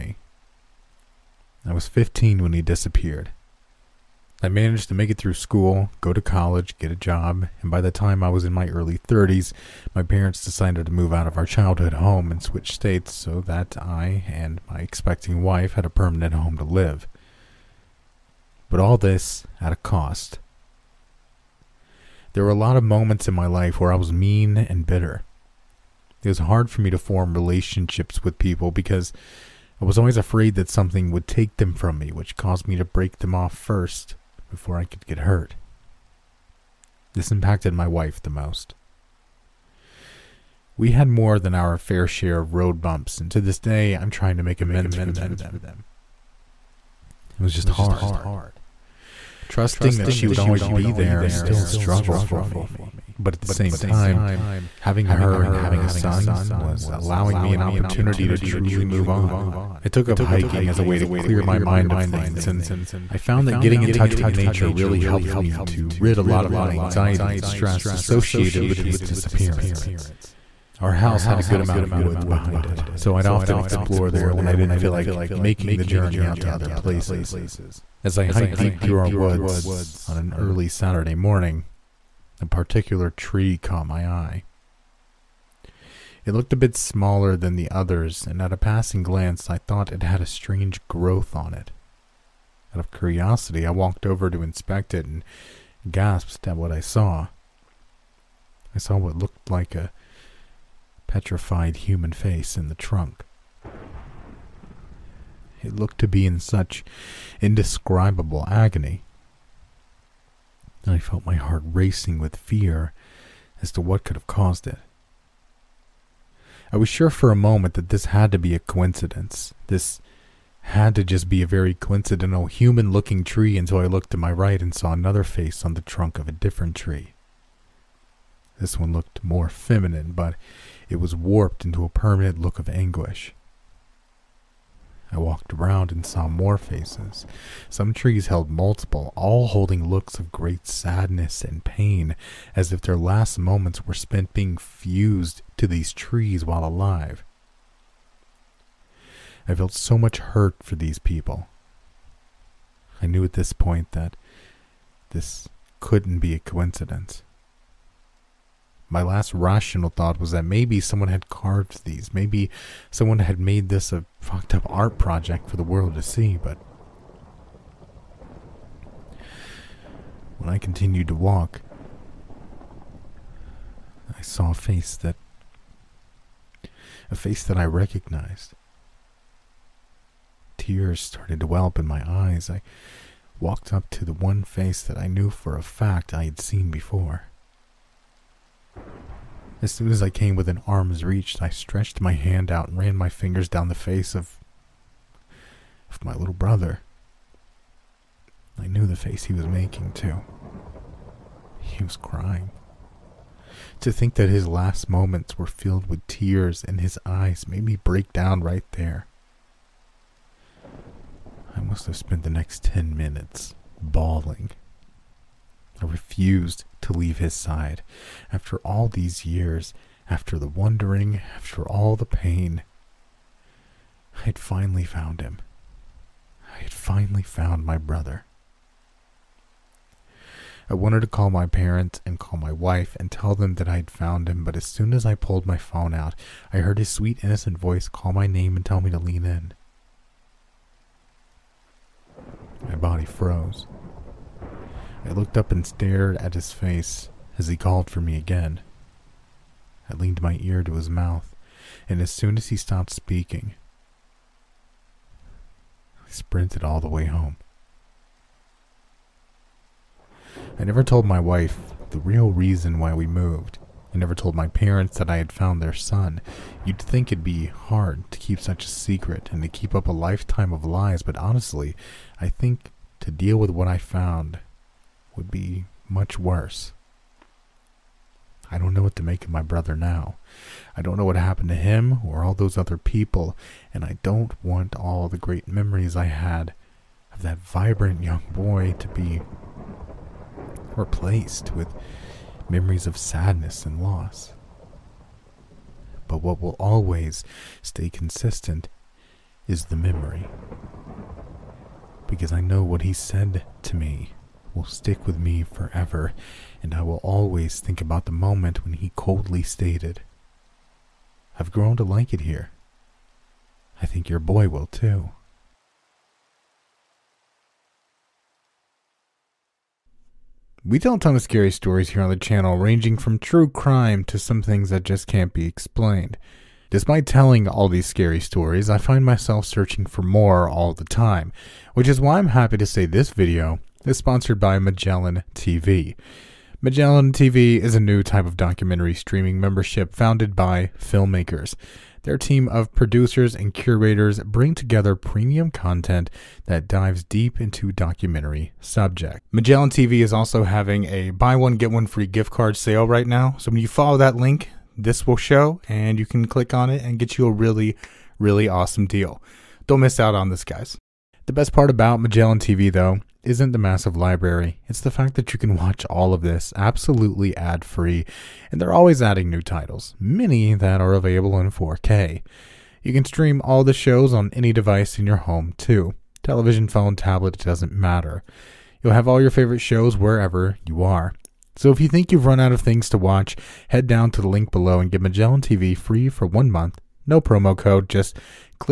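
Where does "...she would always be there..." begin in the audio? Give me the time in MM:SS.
00:50.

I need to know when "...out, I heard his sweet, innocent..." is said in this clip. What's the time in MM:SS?
03:55.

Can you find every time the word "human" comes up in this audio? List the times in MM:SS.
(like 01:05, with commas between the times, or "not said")
01:41, 02:02.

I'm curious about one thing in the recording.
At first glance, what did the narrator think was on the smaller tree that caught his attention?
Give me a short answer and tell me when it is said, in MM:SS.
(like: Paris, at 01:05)
A strange growth, at 01:30.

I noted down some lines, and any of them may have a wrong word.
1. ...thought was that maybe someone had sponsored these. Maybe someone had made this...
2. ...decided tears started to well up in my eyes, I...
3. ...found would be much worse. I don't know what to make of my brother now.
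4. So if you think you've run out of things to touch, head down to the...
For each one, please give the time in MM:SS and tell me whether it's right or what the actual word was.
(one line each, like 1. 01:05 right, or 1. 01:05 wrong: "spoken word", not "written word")
1. 02:39 wrong: "carved", not "sponsored"
2. 02:57 wrong: "recognized", not "decided"
3. 04:33 right
4. 06:21 wrong: "watch", not "touch".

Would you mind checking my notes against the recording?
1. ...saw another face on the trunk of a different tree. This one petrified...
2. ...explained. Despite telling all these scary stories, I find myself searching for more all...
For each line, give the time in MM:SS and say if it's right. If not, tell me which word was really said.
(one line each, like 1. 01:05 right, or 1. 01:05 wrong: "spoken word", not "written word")
1. 02:04 wrong: "looked", not "petrified"
2. 05:25 right.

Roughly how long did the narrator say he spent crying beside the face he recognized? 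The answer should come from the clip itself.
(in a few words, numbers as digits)
10 minutes.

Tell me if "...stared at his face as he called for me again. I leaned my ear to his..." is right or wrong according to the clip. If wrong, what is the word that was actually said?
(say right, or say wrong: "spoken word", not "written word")
right.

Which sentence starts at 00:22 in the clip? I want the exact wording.
There were a lot of moments in my life where I was mean and bitter.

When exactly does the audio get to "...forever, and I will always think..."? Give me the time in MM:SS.
05:05.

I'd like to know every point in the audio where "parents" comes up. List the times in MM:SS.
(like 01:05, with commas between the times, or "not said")
00:10, 03:51, 04:24.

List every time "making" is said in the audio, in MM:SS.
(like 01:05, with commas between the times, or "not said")
01:15, 03:19.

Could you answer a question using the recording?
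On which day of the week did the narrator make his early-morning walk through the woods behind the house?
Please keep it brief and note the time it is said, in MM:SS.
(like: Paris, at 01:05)
Saturday, at 01:20.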